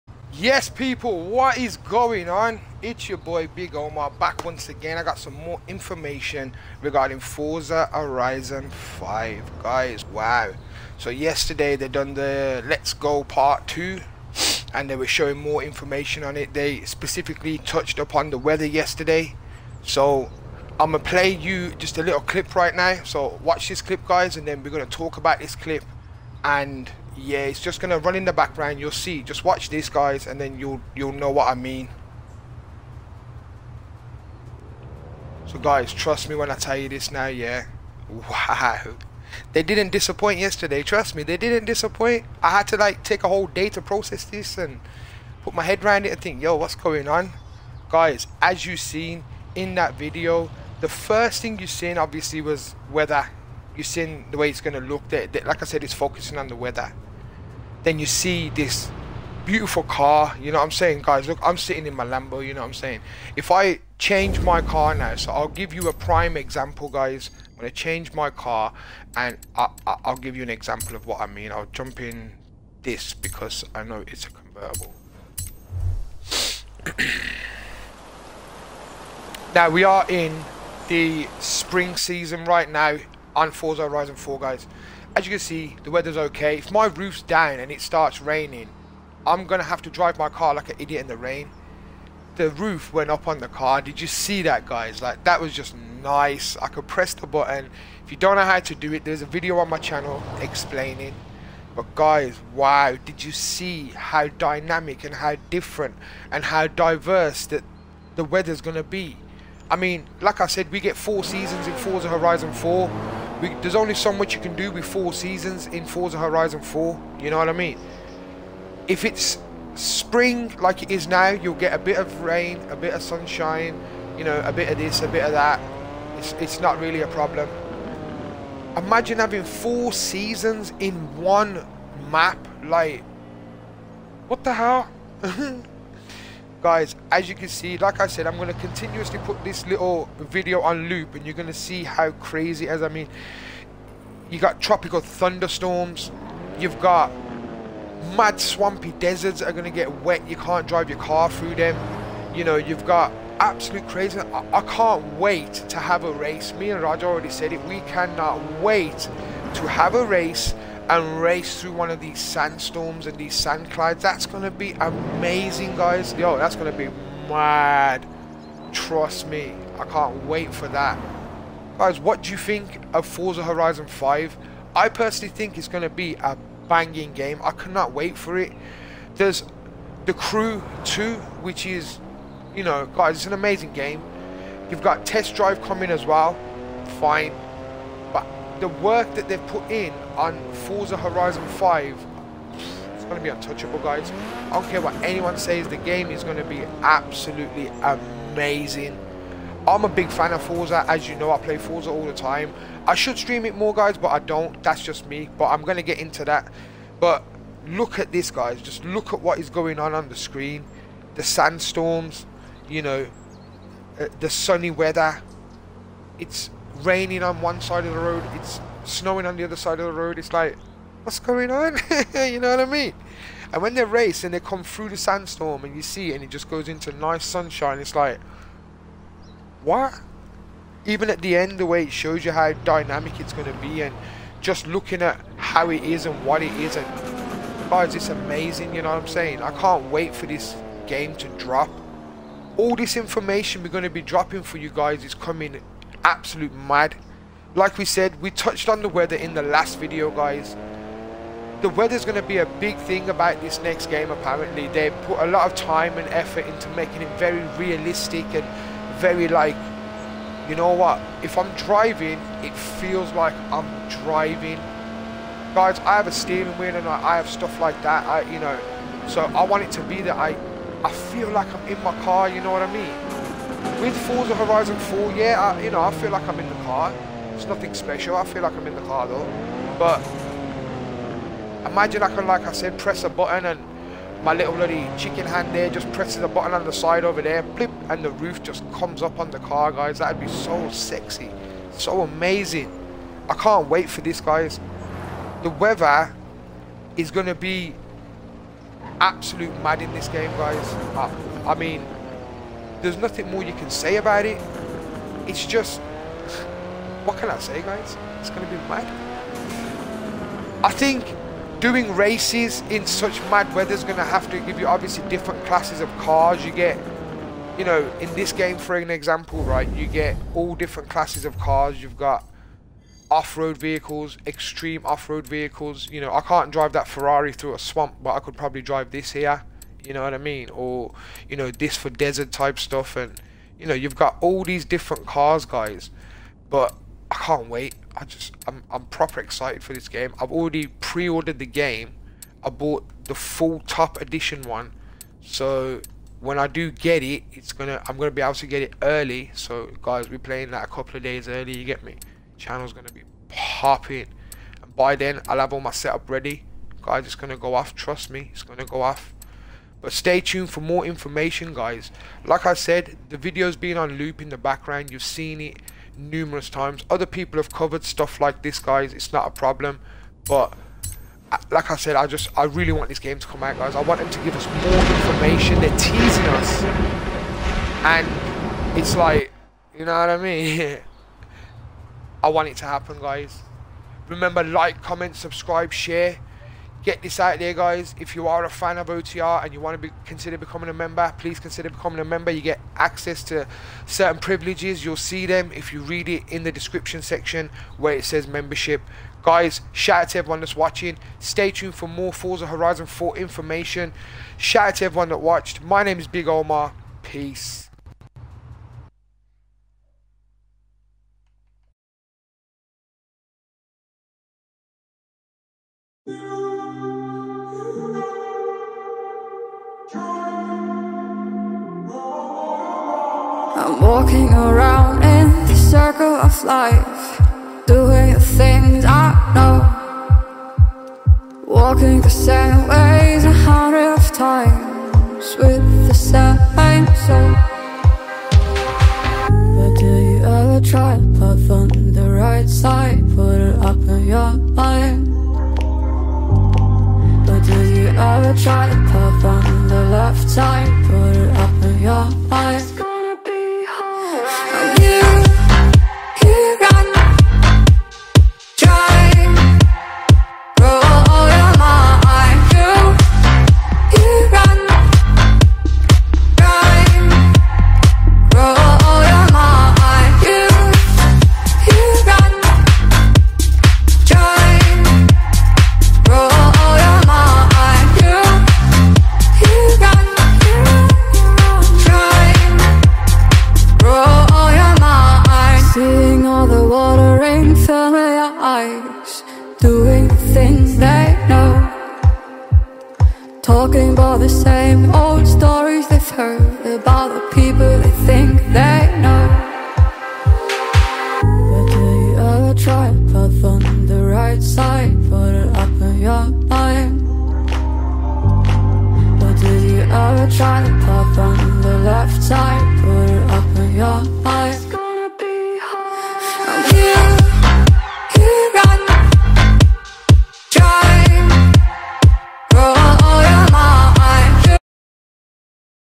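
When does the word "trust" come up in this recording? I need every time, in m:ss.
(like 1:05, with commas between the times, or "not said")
0:35, 0:40, 2:48, 5:57.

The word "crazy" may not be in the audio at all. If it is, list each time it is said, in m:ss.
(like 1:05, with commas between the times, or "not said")
2:22, 2:33.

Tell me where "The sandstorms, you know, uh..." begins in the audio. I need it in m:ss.
3:31.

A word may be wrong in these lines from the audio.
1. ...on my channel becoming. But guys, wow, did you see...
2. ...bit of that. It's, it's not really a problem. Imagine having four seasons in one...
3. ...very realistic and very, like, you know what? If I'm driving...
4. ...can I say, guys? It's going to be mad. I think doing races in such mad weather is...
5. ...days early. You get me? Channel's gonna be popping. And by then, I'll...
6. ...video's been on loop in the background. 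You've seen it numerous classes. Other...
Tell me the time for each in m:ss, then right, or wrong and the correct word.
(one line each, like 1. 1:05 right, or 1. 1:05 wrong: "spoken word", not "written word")
1. 1:39 wrong: "explaining", not "becoming"
2. 2:05 right
3. 4:17 right
4. 5:07 right
5. 5:51 right
6. 6:03 wrong: "times", not "classes".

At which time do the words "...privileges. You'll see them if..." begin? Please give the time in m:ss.
6:34.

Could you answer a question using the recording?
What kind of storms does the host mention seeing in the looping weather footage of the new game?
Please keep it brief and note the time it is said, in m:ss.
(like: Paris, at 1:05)
Tropical thunderstorms, at 2:24.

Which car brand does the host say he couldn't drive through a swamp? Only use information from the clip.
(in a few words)
Ferrari.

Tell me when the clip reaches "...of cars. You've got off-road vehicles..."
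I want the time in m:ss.
5:21.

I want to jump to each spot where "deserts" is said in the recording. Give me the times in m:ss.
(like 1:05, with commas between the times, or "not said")
2:28, 5:31.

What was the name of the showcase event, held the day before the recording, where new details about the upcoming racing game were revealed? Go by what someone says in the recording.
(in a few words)
Let's Go Part 2.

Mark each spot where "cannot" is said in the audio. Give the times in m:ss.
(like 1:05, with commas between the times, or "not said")
2:37, 2:57.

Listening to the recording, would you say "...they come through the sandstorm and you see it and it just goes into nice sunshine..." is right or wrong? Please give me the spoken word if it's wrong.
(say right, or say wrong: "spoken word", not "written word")
right.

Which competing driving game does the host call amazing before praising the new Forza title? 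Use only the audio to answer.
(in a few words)
The Crew 2.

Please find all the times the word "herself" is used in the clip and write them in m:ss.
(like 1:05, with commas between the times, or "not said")
not said.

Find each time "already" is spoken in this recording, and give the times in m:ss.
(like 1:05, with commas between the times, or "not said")
2:37, 5:40.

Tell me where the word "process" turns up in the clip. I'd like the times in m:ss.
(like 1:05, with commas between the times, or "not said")
0:43.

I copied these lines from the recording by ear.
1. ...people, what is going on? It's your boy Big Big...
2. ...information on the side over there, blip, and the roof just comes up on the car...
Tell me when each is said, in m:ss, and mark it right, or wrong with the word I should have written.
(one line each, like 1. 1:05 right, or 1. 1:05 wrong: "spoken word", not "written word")
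1. 0:00 wrong: "Omar", not "Big"
2. 4:46 wrong: "button", not "information".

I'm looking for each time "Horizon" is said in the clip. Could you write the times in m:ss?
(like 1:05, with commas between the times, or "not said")
0:07, 1:23, 1:52, 1:56, 2:53, 3:10, 4:34, 6:42.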